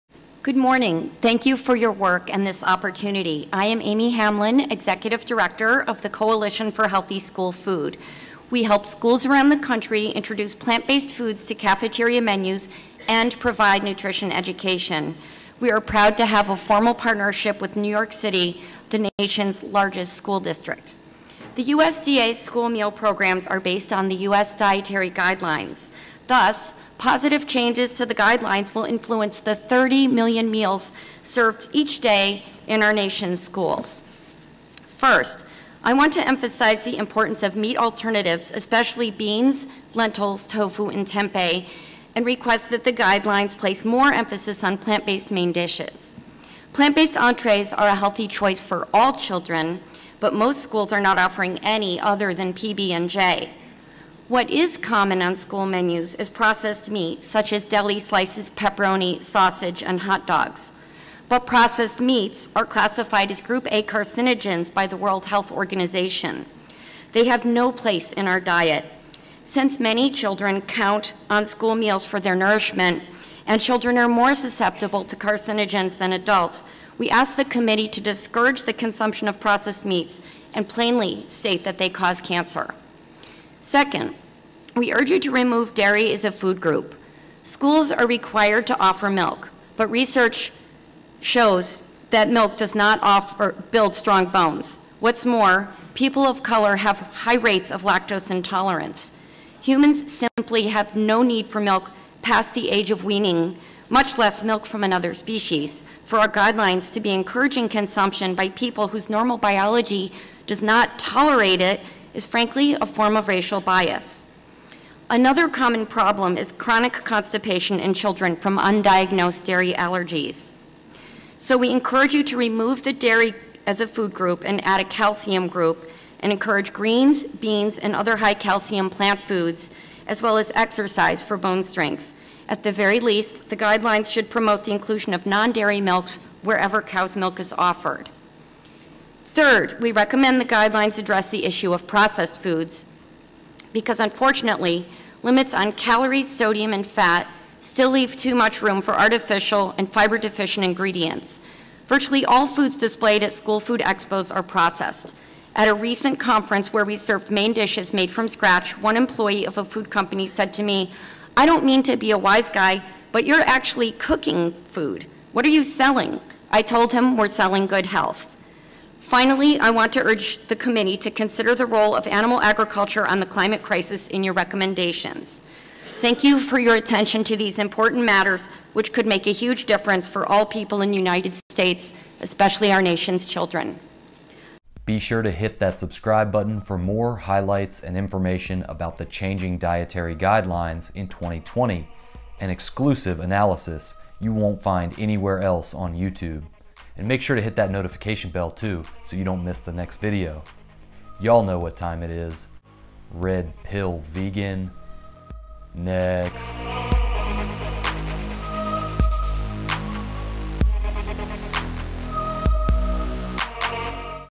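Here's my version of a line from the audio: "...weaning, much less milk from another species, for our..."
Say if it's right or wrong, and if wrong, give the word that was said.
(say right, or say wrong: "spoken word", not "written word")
right.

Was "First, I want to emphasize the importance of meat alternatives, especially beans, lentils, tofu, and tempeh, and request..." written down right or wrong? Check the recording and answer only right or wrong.
right.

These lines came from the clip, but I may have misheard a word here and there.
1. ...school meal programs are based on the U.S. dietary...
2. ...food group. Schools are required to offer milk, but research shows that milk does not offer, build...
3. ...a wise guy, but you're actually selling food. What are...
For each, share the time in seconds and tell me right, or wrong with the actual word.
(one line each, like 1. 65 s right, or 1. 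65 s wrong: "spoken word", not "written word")
1. 22 s right
2. 86 s right
3. 162 s wrong: "cooking", not "selling".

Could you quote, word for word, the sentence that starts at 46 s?
Plant-based entrees are a healthy choice for all children, but most schools are not offering any other than PB&J.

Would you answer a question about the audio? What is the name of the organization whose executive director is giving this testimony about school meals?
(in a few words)
Coalition for Healthy School Food.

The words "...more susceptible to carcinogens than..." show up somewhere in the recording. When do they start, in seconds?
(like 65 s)
74 s.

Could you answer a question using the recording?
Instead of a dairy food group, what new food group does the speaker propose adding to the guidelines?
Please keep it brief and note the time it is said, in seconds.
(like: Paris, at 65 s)
a calcium group, at 124 s.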